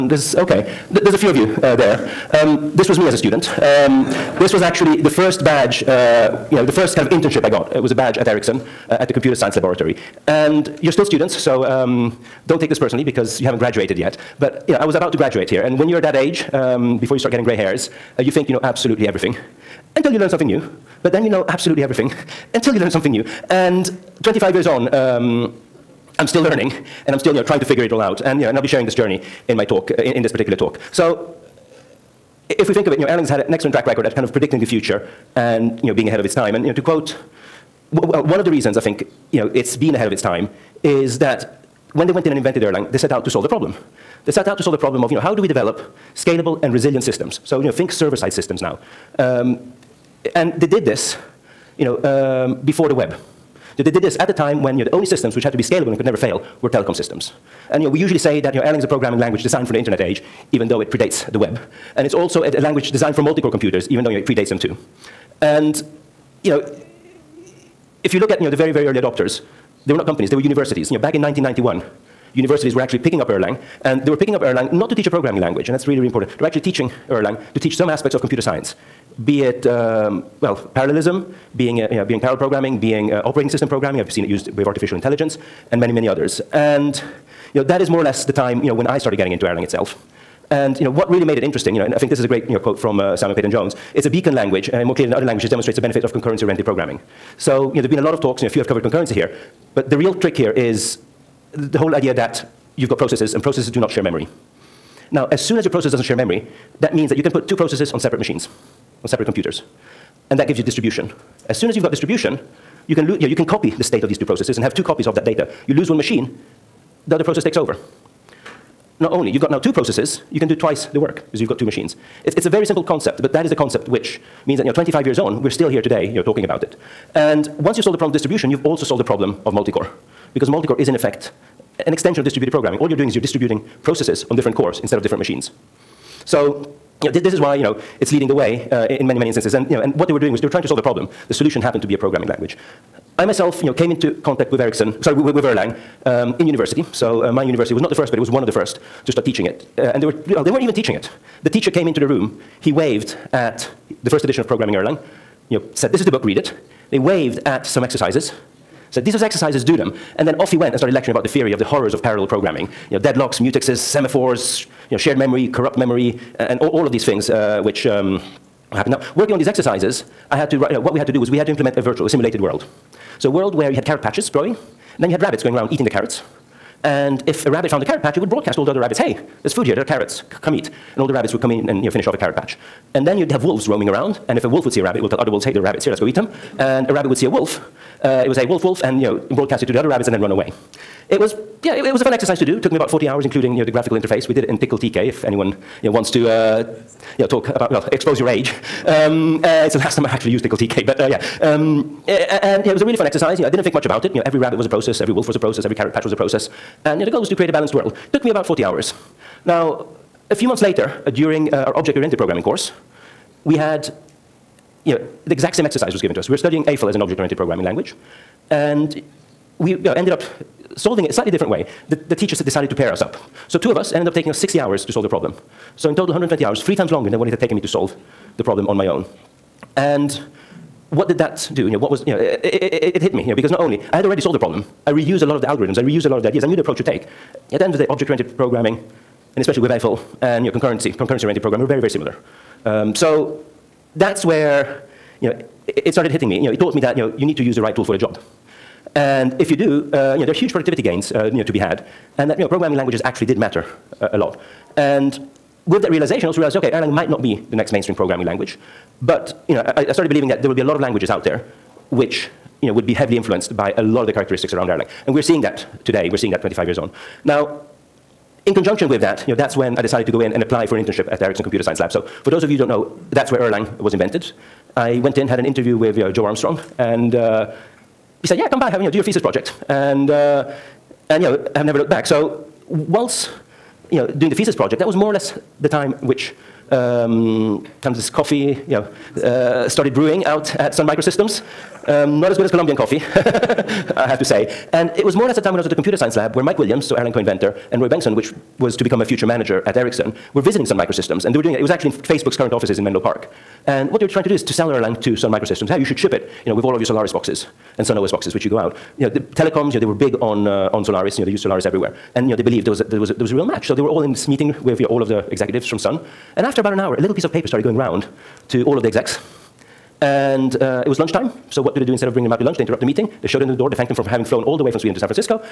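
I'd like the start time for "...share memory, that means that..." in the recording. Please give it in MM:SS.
01:46.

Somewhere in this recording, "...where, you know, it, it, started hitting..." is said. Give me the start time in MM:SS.
04:04.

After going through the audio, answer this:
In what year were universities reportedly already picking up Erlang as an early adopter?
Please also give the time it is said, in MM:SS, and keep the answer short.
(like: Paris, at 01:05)
1991, at 01:11.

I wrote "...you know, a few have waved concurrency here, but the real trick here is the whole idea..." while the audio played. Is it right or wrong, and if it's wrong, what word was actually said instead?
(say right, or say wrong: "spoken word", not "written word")
wrong: "covered", not "waved".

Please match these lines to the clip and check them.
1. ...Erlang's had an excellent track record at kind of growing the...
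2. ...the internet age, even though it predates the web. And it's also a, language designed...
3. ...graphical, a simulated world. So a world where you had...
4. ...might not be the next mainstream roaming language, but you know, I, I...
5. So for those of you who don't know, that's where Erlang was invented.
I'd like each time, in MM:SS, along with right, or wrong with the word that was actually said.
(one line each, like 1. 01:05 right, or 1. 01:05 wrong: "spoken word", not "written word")
1. 00:33 wrong: "predicting", not "growing"
2. 00:59 right
3. 02:51 wrong: "virtual", not "graphical"
4. 04:16 wrong: "programming", not "roaming"
5. 04:31 right.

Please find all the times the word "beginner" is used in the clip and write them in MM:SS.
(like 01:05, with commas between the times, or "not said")
not said.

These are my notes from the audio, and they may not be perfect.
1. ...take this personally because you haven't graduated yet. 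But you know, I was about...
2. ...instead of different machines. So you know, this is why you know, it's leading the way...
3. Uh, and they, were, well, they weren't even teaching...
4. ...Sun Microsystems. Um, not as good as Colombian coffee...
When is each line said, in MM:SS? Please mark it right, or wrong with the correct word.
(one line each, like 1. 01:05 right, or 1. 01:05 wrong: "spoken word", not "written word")
1. 00:12 right
2. 02:14 right
3. 02:29 right
4. 04:50 right.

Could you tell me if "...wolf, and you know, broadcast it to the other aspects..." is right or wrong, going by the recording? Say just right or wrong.
wrong.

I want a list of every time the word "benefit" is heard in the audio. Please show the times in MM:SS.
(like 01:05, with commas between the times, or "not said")
01:35.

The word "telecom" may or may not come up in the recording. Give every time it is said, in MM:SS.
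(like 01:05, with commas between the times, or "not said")
00:56, 05:09.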